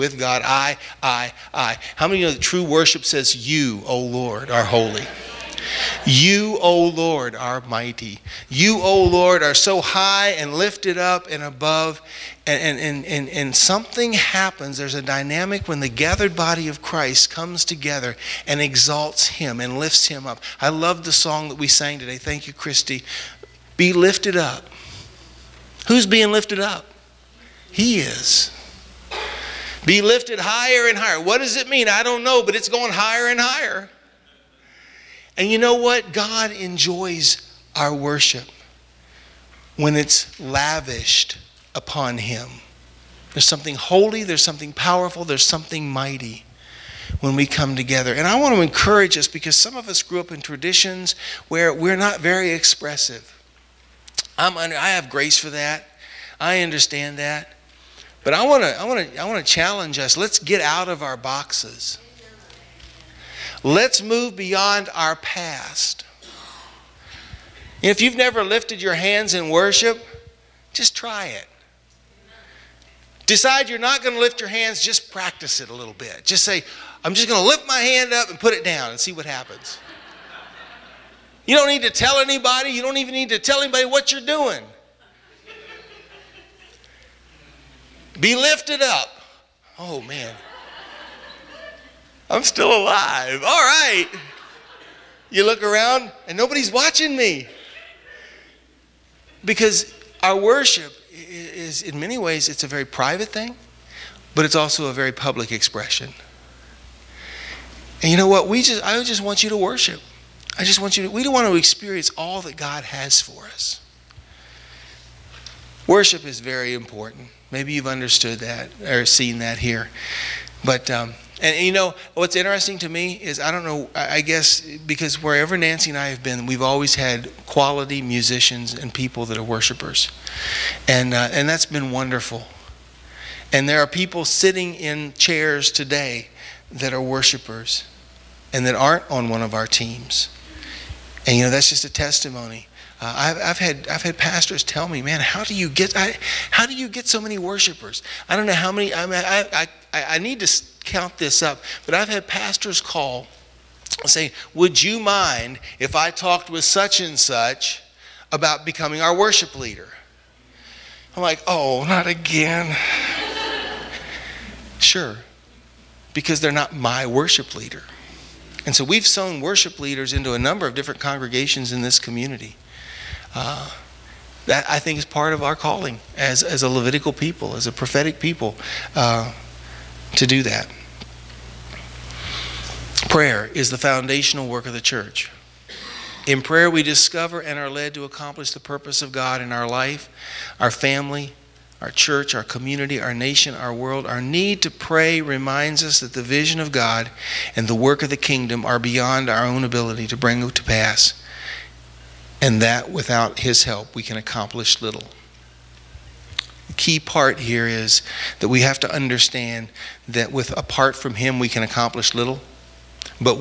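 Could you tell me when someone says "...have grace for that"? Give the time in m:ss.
0:54.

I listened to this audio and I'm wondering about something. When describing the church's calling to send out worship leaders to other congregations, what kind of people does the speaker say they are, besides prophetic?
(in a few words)
Levitical.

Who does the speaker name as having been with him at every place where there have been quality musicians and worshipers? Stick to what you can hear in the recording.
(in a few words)
Nancy.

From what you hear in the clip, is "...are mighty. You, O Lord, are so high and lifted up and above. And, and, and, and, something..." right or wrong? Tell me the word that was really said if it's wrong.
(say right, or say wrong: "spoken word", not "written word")
right.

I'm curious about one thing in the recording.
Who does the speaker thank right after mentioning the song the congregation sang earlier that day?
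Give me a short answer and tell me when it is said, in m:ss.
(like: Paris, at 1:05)
Christy, at 0:22.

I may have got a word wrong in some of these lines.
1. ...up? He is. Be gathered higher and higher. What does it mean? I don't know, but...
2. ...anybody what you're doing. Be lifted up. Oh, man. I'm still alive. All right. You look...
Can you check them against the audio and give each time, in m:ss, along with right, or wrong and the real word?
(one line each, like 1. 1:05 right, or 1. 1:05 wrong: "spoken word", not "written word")
1. 0:26 wrong: "lifted", not "gathered"
2. 1:23 right.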